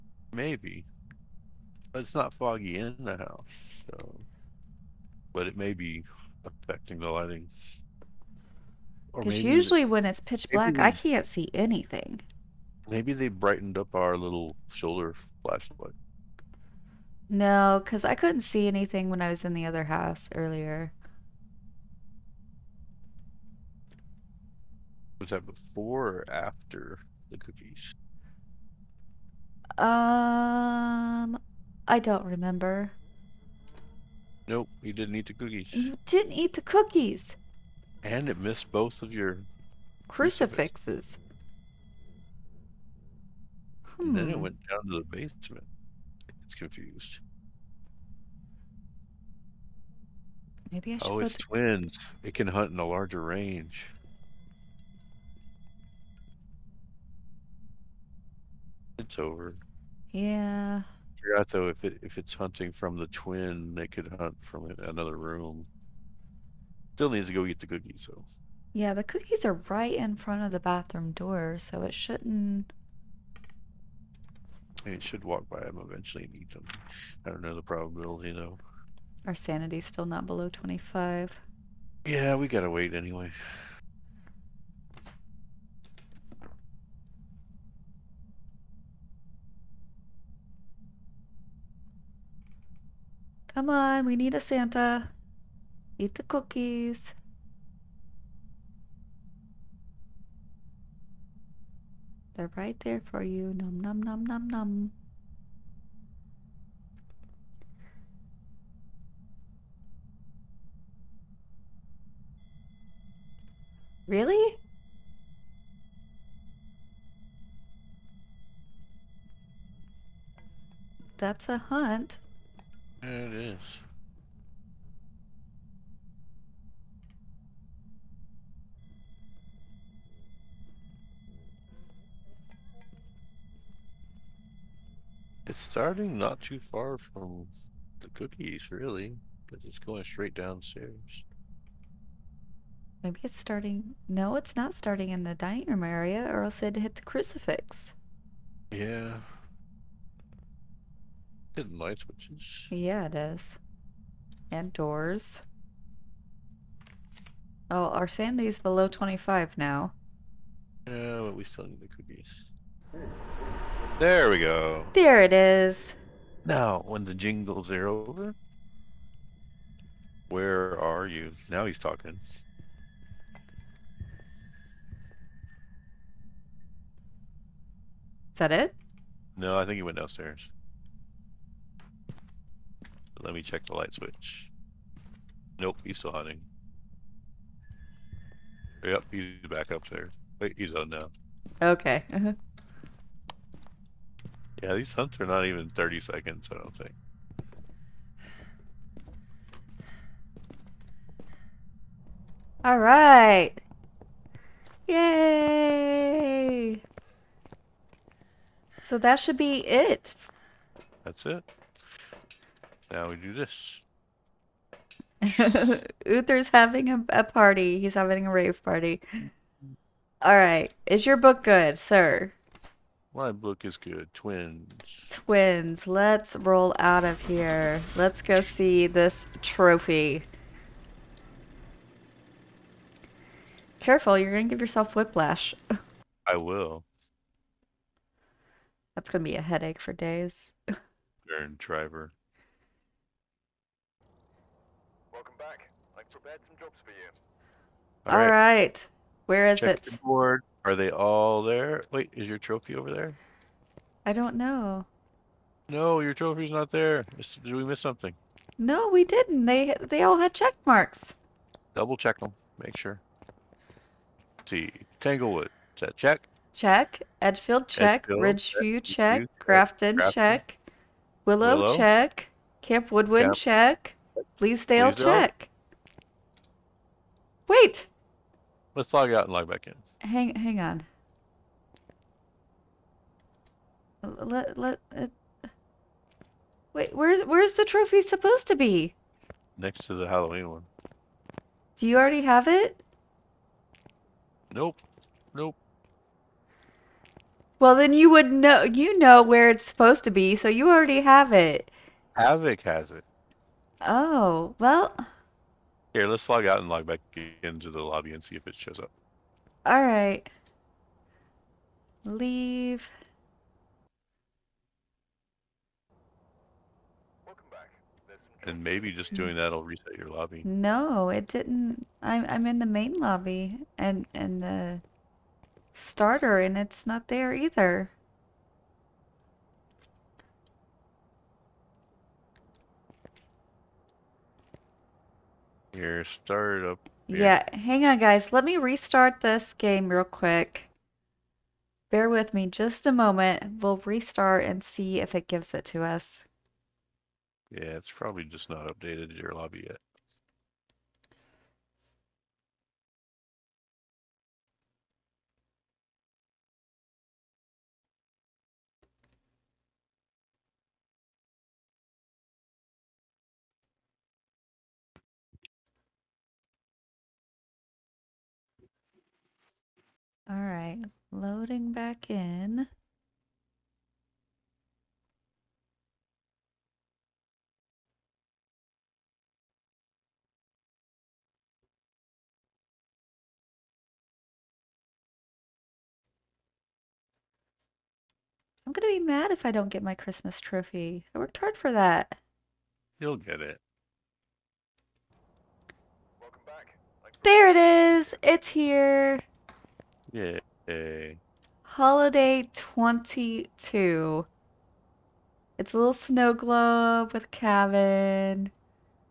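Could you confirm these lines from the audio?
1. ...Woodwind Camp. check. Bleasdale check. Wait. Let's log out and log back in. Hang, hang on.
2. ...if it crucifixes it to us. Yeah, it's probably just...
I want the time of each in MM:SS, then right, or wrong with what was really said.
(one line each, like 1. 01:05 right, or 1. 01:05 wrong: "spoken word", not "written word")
1. 04:32 right
2. 05:45 wrong: "gives", not "crucifixes".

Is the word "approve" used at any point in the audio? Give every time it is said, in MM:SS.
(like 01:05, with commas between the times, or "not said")
not said.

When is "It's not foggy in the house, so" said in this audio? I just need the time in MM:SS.
00:01.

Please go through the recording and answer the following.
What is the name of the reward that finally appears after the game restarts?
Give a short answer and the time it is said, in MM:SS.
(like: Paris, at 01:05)
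Holiday 22, at 06:41.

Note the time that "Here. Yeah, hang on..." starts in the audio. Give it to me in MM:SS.
05:37.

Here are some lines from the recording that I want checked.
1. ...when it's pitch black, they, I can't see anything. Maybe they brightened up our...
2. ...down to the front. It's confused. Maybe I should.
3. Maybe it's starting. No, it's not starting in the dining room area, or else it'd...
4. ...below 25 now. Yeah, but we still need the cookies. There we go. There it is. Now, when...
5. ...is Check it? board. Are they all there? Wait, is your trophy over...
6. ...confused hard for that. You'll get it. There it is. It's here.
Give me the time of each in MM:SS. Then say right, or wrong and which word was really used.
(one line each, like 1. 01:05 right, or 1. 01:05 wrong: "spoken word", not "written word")
1. 00:09 right
2. 00:44 wrong: "basement", not "front"
3. 02:23 right
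4. 02:38 right
5. 04:09 right
6. 06:31 wrong: "worked", not "confused".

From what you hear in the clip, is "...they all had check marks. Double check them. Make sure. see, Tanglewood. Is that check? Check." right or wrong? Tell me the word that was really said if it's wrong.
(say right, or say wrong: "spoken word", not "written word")
right.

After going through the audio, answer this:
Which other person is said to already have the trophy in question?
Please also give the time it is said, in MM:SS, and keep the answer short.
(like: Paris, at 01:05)
Havoc, at 05:02.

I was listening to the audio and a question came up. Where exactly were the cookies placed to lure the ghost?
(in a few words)
In front of the bathroom door.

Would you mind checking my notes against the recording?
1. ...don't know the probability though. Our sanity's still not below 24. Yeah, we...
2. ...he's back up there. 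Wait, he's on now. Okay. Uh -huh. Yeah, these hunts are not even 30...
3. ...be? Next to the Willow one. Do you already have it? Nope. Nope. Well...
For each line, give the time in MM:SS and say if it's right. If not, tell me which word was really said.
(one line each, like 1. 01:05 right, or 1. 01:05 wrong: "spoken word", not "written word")
1. 01:17 wrong: "25", not "24"
2. 03:09 right
3. 04:48 wrong: "Halloween", not "Willow".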